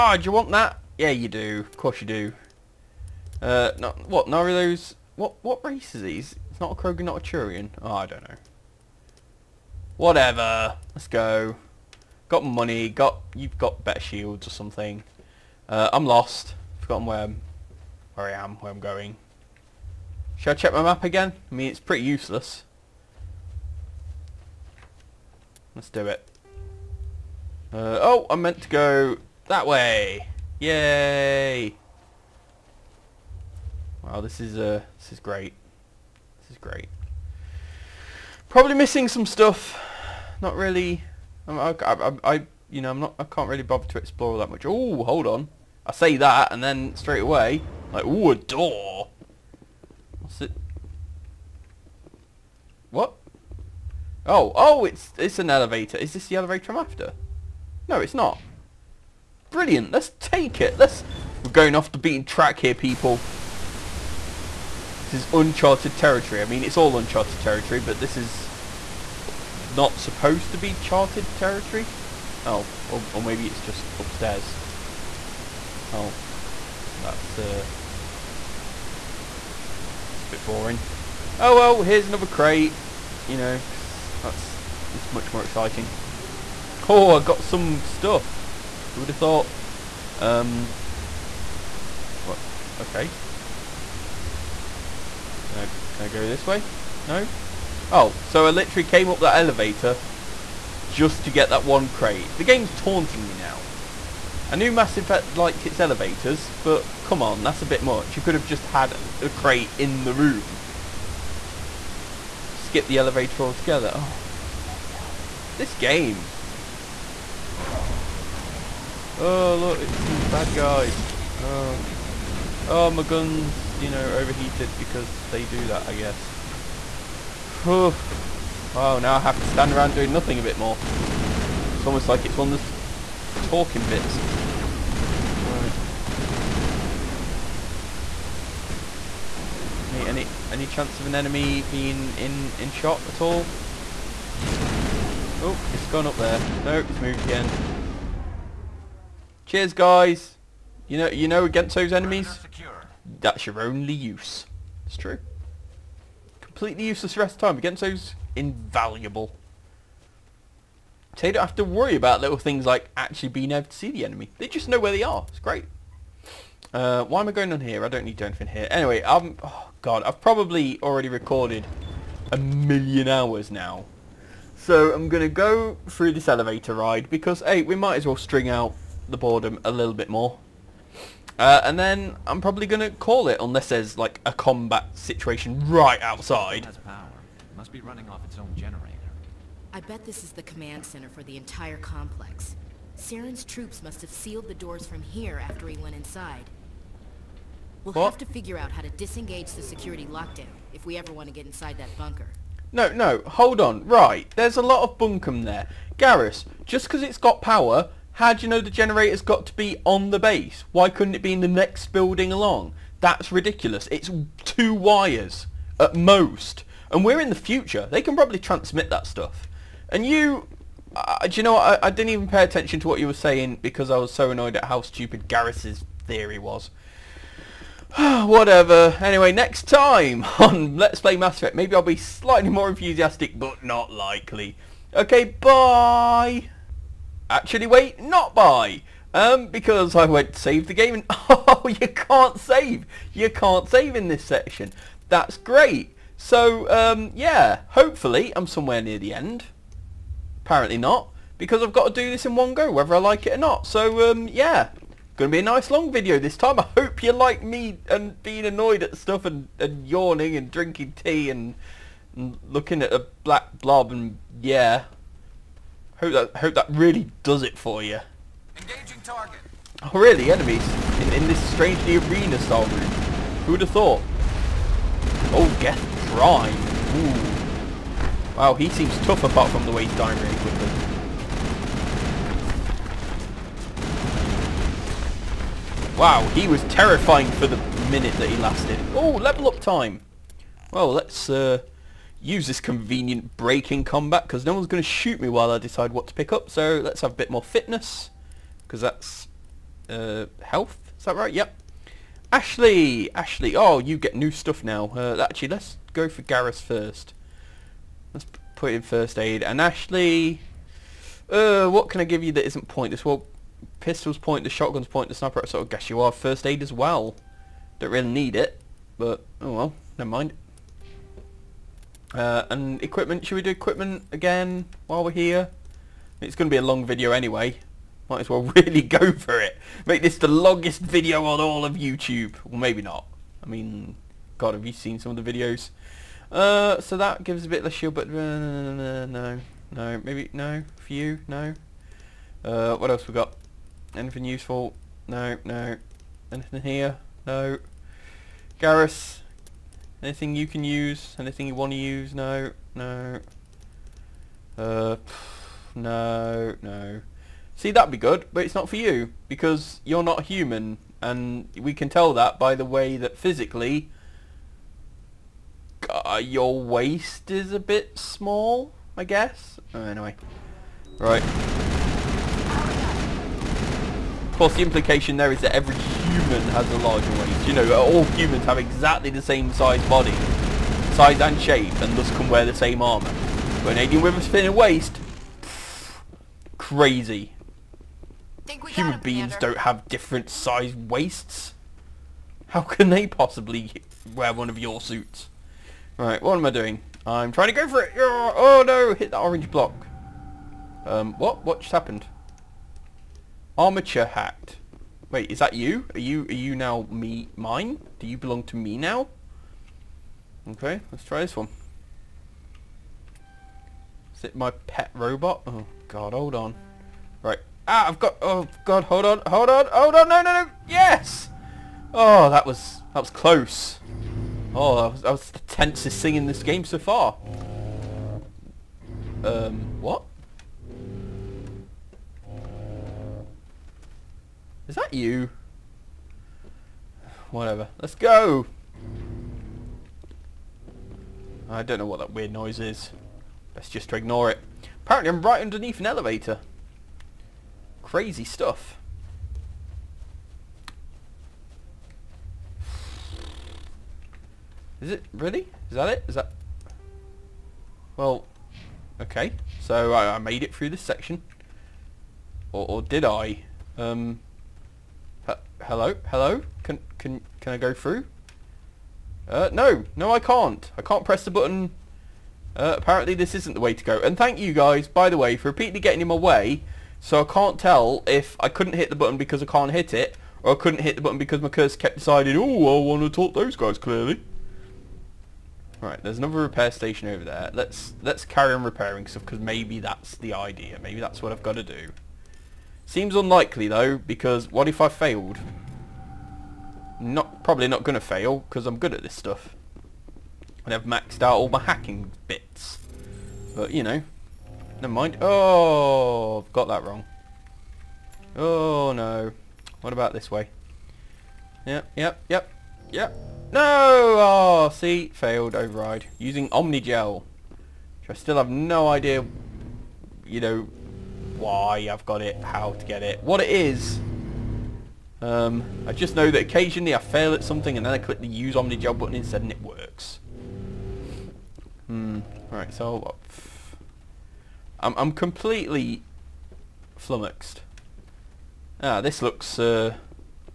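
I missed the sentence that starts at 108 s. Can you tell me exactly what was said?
You could have just had a crate in the room skip the elevator altogether.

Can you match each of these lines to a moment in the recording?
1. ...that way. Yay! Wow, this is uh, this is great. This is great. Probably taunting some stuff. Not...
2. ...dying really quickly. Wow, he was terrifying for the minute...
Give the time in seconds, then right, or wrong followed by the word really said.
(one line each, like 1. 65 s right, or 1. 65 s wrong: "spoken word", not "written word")
1. 29 s wrong: "missing", not "taunting"
2. 279 s right.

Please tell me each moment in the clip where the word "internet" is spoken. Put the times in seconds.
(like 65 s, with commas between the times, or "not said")
not said.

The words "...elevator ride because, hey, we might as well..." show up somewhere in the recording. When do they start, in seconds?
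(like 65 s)
176 s.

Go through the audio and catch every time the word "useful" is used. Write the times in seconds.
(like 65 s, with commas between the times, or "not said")
344 s.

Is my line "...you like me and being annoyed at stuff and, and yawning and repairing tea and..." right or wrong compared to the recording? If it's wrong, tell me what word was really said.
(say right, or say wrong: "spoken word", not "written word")
wrong: "drinking", not "repairing".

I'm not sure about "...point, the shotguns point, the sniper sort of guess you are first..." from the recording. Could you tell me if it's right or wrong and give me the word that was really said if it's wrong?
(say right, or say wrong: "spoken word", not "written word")
right.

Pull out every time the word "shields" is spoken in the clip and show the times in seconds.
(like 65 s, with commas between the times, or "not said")
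13 s, 337 s.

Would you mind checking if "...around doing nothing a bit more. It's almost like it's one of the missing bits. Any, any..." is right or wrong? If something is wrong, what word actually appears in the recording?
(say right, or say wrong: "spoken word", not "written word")
wrong: "talking", not "missing".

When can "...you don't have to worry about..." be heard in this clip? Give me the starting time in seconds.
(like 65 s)
161 s.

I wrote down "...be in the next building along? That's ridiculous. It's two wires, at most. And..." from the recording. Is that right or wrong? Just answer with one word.
right.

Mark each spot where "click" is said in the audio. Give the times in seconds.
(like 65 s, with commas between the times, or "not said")
527 s.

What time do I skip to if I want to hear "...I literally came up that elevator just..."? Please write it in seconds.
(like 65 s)
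98 s.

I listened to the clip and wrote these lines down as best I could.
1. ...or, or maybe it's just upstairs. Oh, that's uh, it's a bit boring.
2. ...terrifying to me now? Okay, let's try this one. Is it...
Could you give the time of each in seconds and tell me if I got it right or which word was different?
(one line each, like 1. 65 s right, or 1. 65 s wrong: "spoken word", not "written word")
1. 72 s right
2. 408 s wrong: "belong", not "terrifying".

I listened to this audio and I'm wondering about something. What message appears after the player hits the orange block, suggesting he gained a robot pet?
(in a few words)
Armature hacked.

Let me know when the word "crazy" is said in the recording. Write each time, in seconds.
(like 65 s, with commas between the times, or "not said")
386 s, 447 s.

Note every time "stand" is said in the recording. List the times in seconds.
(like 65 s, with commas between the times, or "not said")
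129 s.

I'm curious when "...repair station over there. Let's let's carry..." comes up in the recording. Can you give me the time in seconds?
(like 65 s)
486 s.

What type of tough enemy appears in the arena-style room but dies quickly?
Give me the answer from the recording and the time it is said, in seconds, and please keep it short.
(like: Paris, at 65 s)
Geth Prime, at 275 s.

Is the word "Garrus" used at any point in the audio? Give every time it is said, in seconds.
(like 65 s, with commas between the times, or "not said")
205 s, 225 s, 306 s, 348 s.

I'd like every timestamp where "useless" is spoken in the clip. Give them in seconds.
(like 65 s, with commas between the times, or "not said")
22 s, 156 s.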